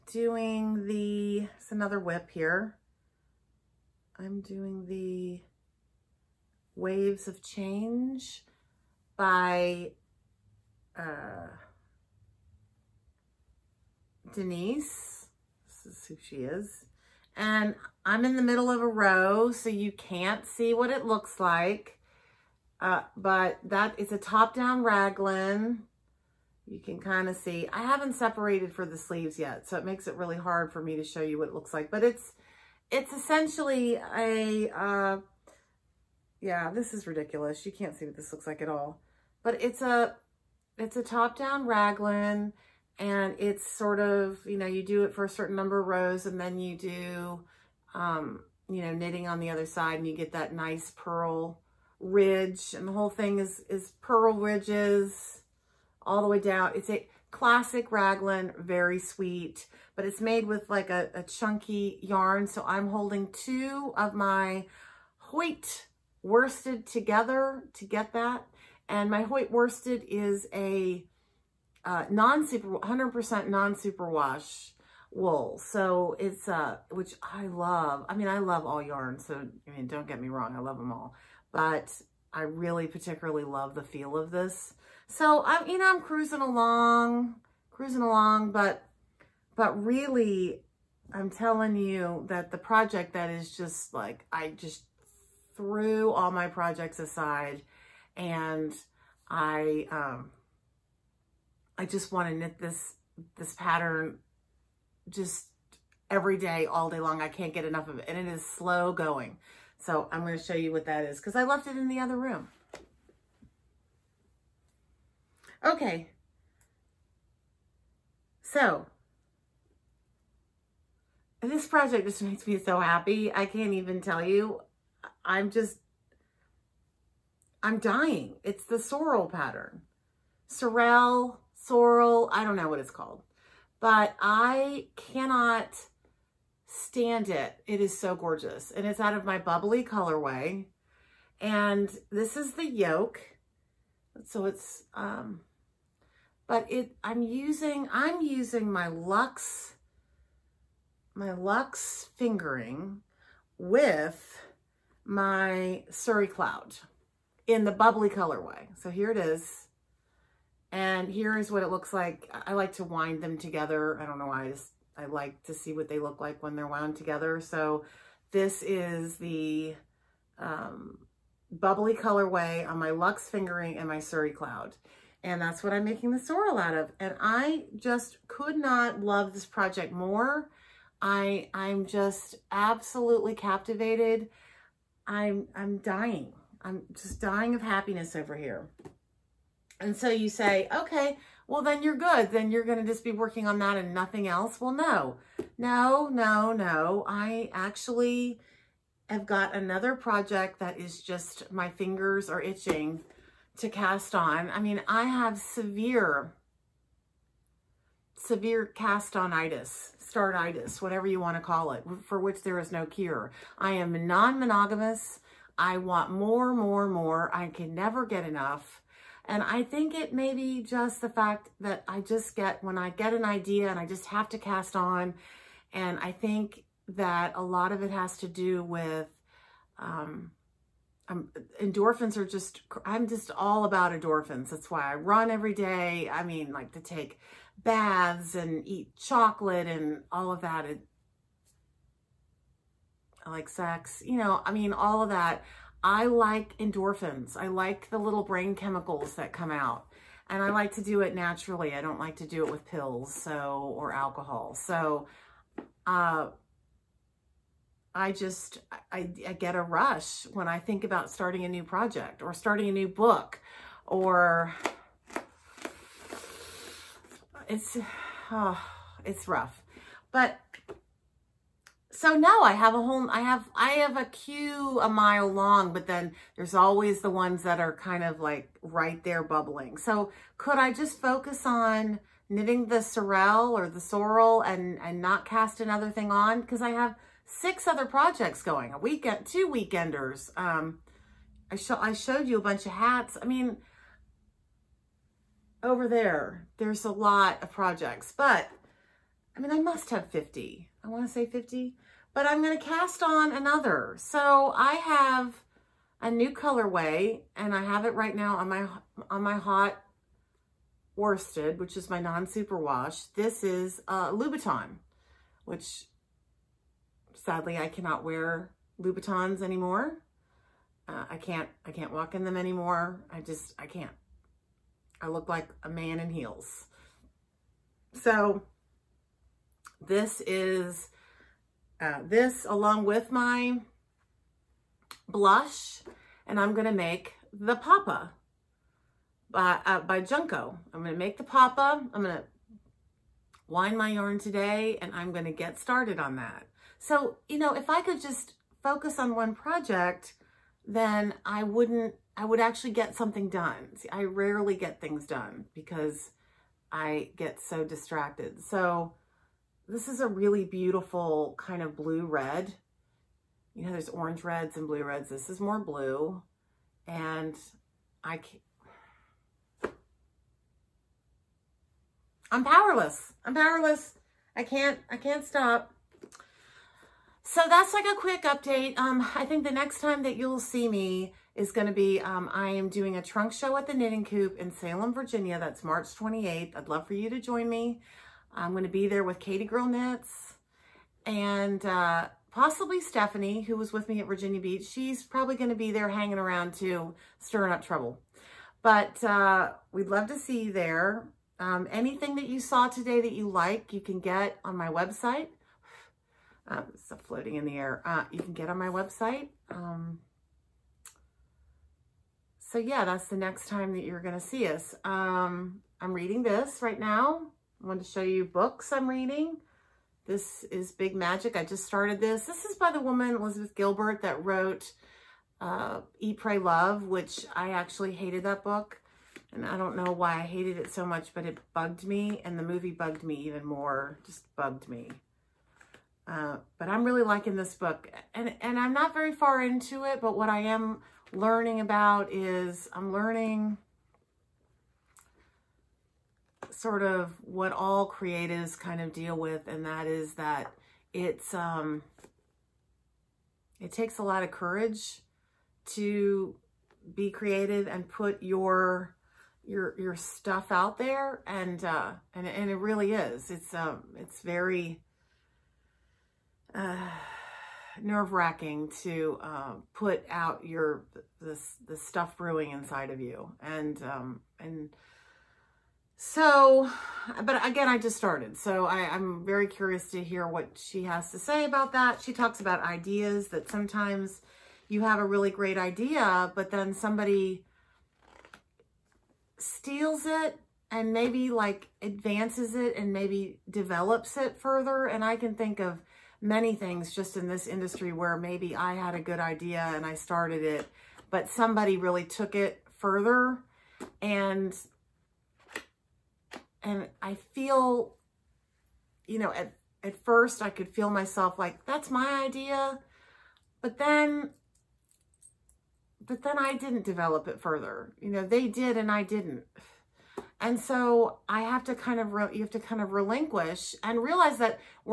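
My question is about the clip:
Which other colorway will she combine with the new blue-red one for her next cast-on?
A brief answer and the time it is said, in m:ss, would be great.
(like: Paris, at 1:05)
blush, at 5:35.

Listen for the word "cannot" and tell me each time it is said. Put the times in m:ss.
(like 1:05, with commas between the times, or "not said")
2:14, 5:17.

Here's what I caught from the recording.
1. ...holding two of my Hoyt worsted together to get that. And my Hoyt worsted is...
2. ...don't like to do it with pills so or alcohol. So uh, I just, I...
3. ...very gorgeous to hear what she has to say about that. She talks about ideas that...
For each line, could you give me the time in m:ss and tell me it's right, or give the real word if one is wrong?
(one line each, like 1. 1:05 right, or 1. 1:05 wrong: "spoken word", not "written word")
1. 1:02 right
2. 4:11 right
3. 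7:59 wrong: "curious", not "gorgeous".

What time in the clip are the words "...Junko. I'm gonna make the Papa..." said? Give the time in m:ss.
5:40.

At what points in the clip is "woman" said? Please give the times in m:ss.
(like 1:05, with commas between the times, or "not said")
7:02.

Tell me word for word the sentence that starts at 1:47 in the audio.
I can't get enough of it.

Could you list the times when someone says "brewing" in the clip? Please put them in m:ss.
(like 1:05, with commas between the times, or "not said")
7:52.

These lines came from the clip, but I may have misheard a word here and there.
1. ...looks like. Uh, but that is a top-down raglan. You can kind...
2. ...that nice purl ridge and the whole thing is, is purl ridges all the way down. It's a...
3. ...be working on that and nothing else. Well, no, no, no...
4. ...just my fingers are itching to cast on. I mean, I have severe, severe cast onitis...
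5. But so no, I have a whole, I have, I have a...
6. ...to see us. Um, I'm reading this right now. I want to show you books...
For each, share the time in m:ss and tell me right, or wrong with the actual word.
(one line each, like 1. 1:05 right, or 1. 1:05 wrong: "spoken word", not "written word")
1. 0:21 right
2. 0:50 right
3. 3:13 right
4. 3:21 right
5. 4:30 right
6. 6:54 right.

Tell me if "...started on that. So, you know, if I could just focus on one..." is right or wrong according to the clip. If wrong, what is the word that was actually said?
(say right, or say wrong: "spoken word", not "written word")
right.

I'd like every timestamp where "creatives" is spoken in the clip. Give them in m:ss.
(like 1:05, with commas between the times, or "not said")
7:27, 7:37.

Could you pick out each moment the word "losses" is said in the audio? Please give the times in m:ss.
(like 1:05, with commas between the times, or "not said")
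not said.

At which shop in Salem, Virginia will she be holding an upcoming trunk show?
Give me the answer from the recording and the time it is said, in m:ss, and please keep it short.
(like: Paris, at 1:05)
the Knitting Coop, at 6:23.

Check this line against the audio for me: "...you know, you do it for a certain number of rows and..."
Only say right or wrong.
right.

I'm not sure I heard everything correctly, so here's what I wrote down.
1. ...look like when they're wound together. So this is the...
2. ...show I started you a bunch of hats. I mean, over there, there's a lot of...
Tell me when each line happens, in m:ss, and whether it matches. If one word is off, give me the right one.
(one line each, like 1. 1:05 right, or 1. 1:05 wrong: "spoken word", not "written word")
1. 2:45 right
2. 4:51 wrong: "showed", not "started".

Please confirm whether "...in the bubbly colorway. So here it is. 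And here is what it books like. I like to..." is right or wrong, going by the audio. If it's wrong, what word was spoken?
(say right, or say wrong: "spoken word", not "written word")
wrong: "looks", not "books".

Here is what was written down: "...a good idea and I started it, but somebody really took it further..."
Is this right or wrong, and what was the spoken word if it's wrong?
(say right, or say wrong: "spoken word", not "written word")
right.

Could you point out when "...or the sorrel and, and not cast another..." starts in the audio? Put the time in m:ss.
4:43.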